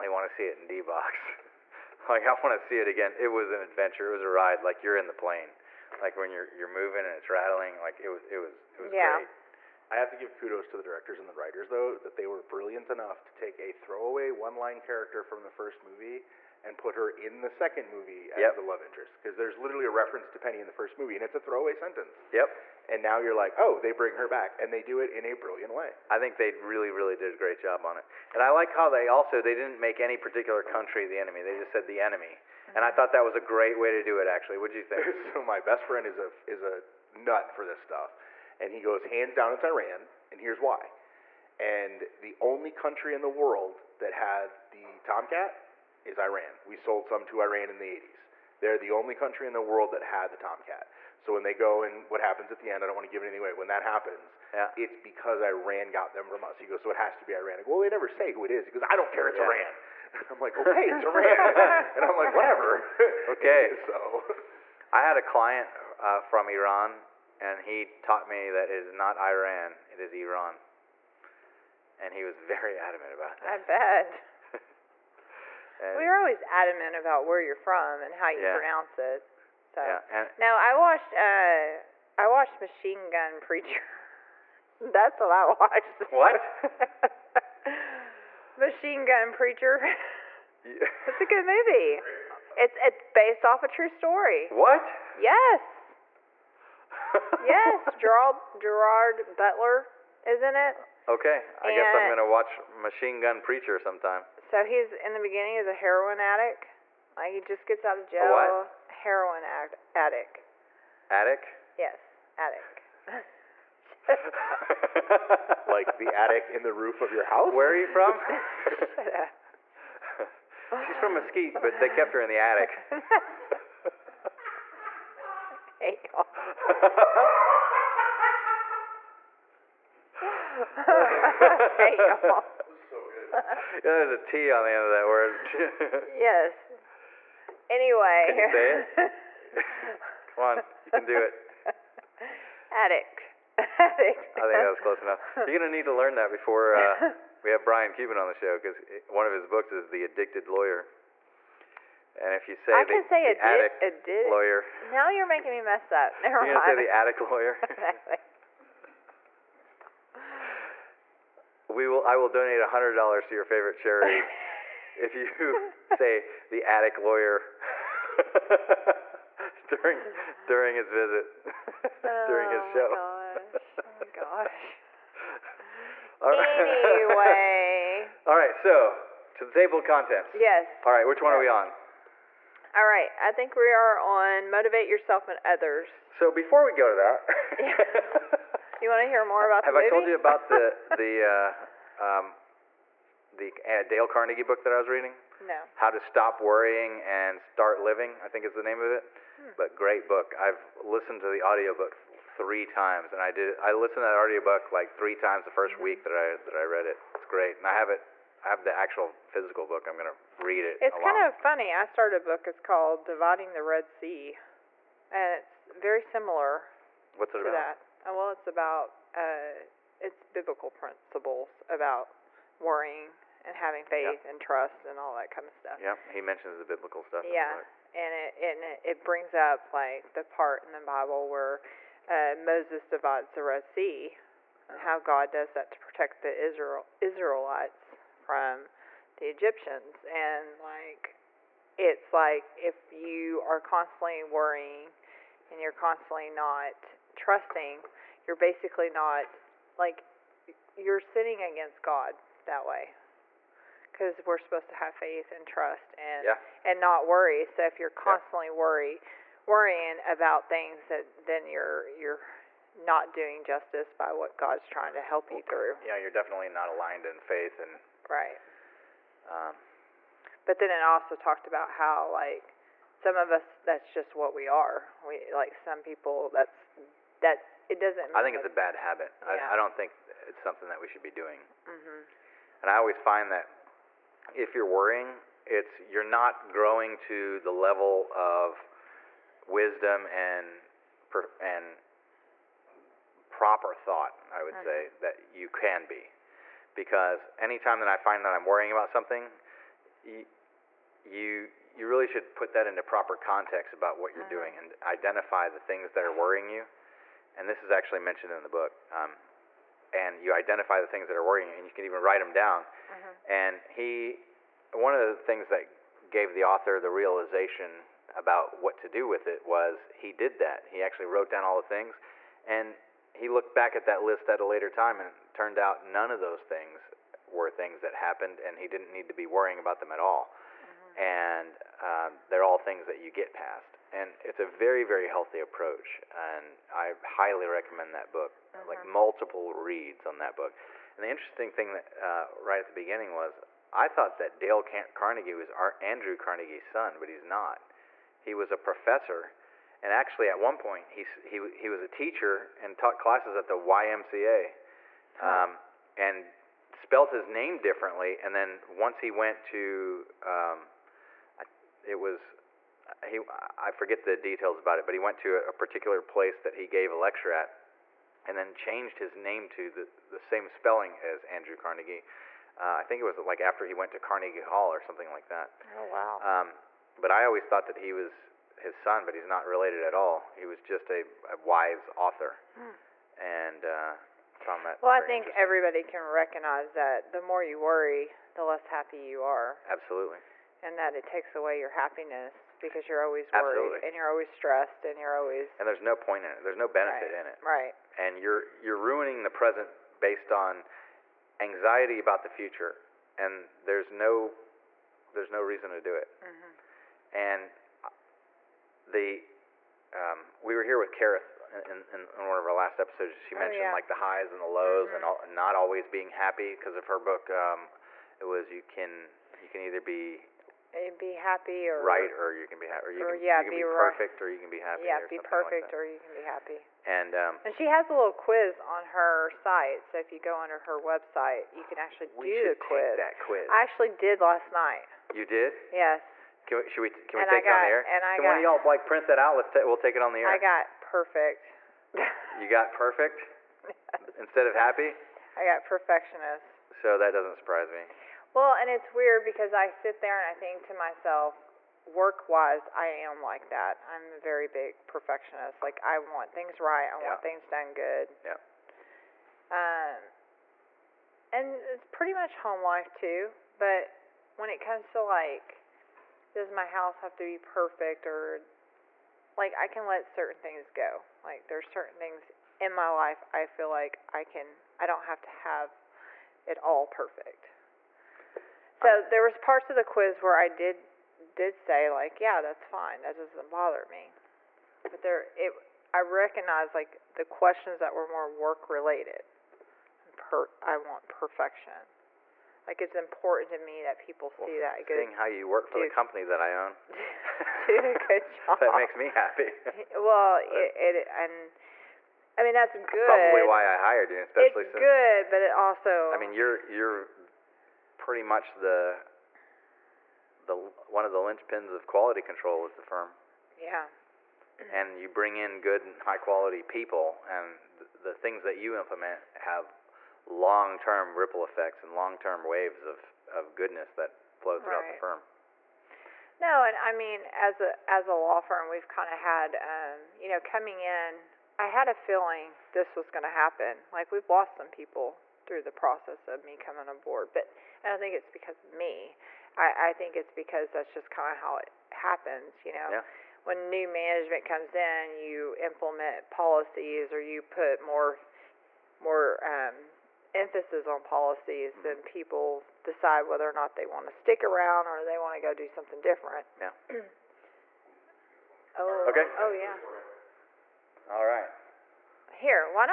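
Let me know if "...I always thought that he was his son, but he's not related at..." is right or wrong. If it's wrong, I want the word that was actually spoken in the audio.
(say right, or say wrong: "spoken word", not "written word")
right.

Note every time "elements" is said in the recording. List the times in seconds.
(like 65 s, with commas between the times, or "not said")
not said.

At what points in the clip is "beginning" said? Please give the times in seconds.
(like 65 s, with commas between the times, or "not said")
105 s, 342 s.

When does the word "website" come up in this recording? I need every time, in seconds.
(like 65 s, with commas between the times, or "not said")
430 s.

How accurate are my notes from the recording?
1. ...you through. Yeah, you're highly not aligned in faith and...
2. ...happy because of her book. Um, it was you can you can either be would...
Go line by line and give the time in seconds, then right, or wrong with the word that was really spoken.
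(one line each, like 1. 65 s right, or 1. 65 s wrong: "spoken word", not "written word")
1. 265 s wrong: "definitely", not "highly"
2. 416 s right.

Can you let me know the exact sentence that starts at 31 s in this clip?
They just said the enemy, mm-hmm.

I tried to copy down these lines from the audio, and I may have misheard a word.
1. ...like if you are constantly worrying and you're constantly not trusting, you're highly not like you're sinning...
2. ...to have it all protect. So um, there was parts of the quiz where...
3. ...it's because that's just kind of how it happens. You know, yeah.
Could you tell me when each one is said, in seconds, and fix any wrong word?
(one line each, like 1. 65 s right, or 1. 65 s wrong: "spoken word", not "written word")
1. 242 s wrong: "basically", not "highly"
2. 475 s wrong: "perfect", not "protect"
3. 540 s right.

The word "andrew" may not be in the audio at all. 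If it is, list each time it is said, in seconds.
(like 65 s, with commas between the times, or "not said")
345 s, 371 s.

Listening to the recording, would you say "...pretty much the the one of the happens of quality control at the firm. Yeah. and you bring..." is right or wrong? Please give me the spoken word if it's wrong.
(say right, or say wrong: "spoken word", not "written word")
wrong: "linchpins", not "happens".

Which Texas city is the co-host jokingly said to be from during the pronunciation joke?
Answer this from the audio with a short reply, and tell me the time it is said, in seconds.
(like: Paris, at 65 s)
Mesquite, at 121 s.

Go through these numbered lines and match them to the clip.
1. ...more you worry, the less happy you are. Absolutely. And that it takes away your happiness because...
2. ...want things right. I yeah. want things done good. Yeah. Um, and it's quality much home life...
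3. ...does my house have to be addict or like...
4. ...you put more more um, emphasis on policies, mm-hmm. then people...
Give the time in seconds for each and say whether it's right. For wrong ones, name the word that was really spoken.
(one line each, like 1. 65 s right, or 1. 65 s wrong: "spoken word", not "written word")
1. 387 s right
2. 455 s wrong: "pretty", not "quality"
3. 466 s wrong: "perfect", not "addict"
4. 547 s right.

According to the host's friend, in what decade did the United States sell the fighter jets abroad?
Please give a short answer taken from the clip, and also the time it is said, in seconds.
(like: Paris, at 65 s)
the 80s, at 47 s.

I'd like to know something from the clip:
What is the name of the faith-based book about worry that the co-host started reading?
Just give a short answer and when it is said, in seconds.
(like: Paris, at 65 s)
Dividing the Red Sea, at 213 s.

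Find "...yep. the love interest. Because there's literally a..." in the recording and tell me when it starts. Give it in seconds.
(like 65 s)
18 s.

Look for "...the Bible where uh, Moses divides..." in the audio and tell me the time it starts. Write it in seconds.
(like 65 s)
230 s.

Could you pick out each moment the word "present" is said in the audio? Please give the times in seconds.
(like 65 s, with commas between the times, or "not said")
399 s.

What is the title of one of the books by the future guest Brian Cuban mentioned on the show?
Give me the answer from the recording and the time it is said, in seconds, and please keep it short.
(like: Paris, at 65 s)
The Addicted Lawyer, at 149 s.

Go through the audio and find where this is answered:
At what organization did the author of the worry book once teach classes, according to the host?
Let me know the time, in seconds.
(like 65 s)
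353 s.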